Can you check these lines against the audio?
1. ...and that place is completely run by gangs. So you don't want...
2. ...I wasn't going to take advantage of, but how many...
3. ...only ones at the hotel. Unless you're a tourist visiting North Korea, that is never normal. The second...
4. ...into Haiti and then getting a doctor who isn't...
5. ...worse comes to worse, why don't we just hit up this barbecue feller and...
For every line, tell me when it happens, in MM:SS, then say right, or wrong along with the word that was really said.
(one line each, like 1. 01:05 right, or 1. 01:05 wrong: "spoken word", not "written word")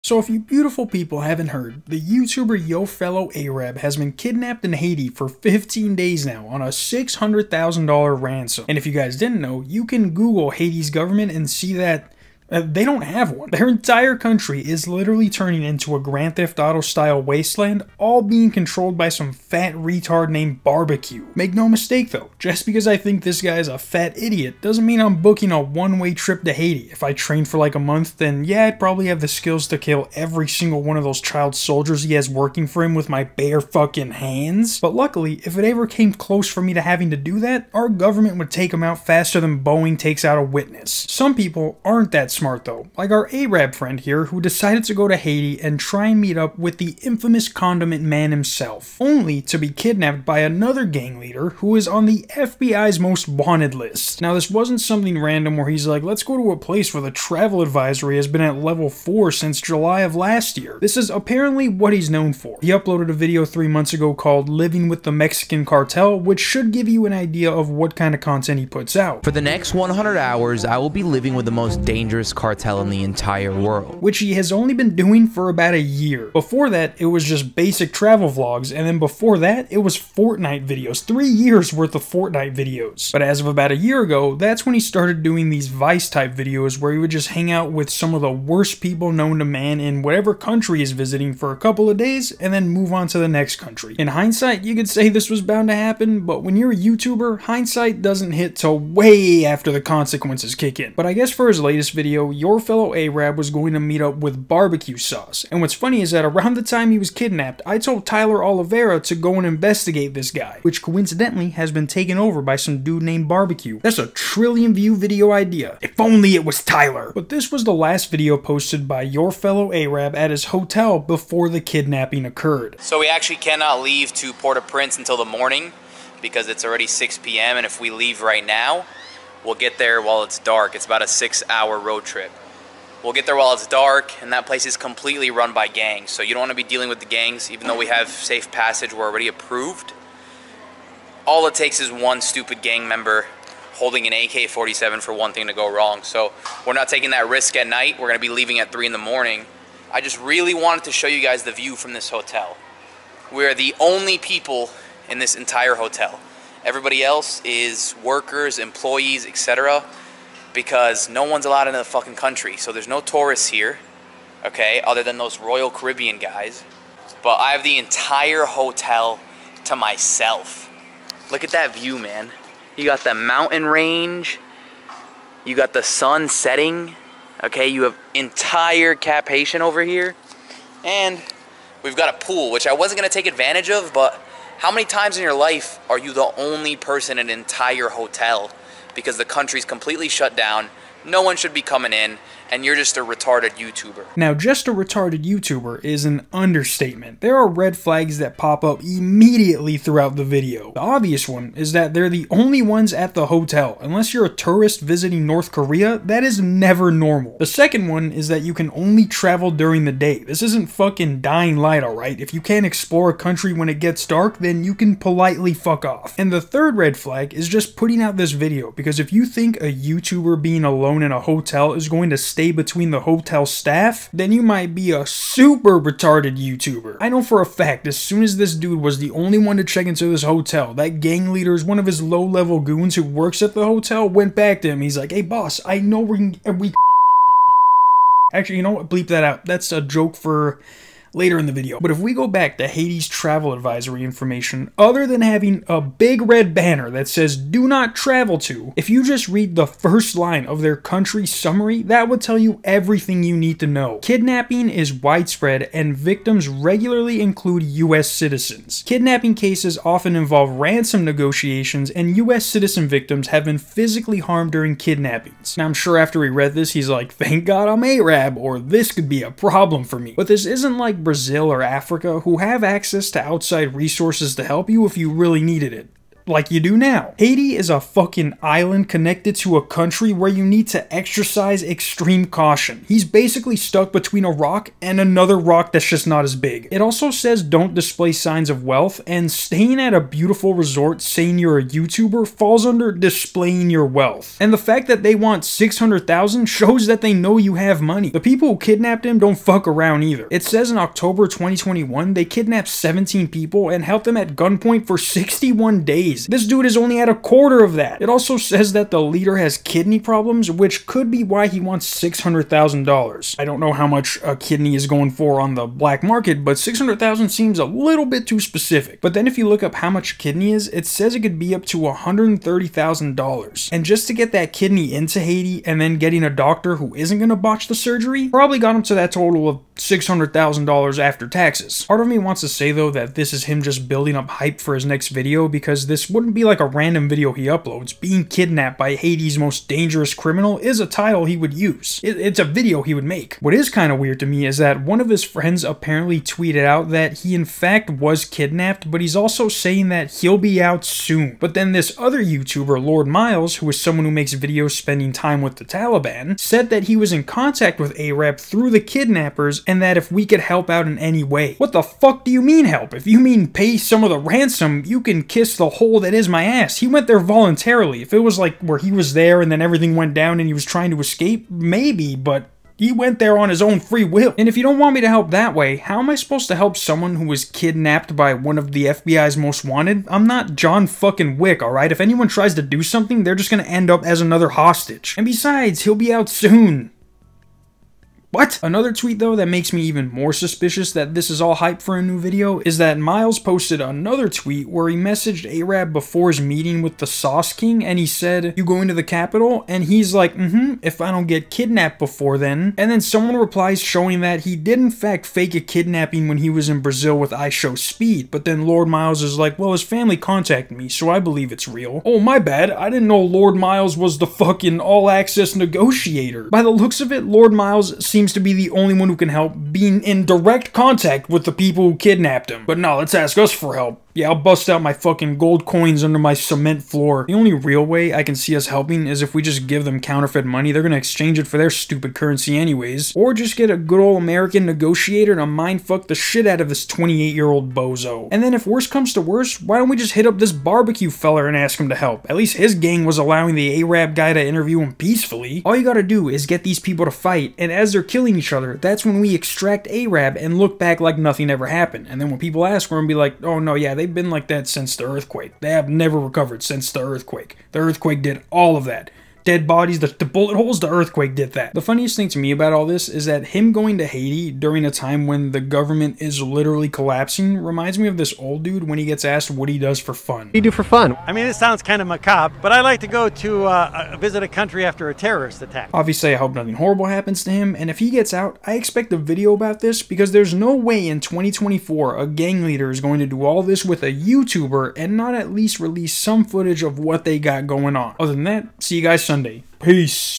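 1. 02:14 right
2. 03:02 right
3. 03:22 right
4. 05:24 right
5. 07:18 right.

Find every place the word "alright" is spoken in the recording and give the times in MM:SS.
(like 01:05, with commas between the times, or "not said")
03:31, 06:21.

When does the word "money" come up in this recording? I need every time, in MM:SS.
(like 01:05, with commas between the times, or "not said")
04:57, 07:10.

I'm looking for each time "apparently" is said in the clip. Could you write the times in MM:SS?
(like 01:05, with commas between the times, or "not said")
01:01, 05:45.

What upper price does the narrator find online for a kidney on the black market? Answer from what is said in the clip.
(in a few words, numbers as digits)
$130,000.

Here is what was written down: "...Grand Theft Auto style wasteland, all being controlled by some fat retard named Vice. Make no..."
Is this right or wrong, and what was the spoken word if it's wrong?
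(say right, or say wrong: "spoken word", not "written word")
wrong: "Barbecue", not "Vice".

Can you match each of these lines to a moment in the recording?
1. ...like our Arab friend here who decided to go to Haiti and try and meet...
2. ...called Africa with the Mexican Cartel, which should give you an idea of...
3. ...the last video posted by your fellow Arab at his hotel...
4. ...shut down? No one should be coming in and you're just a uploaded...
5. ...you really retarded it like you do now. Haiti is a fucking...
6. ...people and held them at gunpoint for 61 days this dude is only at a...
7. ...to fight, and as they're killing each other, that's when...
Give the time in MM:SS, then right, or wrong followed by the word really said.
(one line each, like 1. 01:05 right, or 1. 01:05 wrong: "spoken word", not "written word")
1. 00:42 right
2. 01:04 wrong: "Living", not "Africa"
3. 01:57 right
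4. 03:10 wrong: "retarded", not "uploaded"
5. 04:34 wrong: "needed", not "retarded"
6. 05:03 right
7. 07:27 right.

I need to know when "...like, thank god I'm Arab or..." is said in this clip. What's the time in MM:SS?
04:26.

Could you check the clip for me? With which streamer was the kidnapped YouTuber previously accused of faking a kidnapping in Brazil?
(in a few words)
IShowSpeed.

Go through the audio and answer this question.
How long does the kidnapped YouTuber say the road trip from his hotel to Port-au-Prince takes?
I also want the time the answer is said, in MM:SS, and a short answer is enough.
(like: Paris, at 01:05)
6 hours, at 02:11.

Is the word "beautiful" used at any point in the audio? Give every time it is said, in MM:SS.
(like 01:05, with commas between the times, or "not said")
00:00, 04:49.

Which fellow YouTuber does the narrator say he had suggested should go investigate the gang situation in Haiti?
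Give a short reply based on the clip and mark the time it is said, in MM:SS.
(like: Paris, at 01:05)
Tyler Oliveira, at 01:48.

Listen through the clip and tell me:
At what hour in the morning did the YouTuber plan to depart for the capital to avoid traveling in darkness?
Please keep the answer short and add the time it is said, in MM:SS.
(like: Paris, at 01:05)
3 a.m., at 02:28.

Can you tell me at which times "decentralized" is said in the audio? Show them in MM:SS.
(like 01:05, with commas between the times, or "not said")
not said.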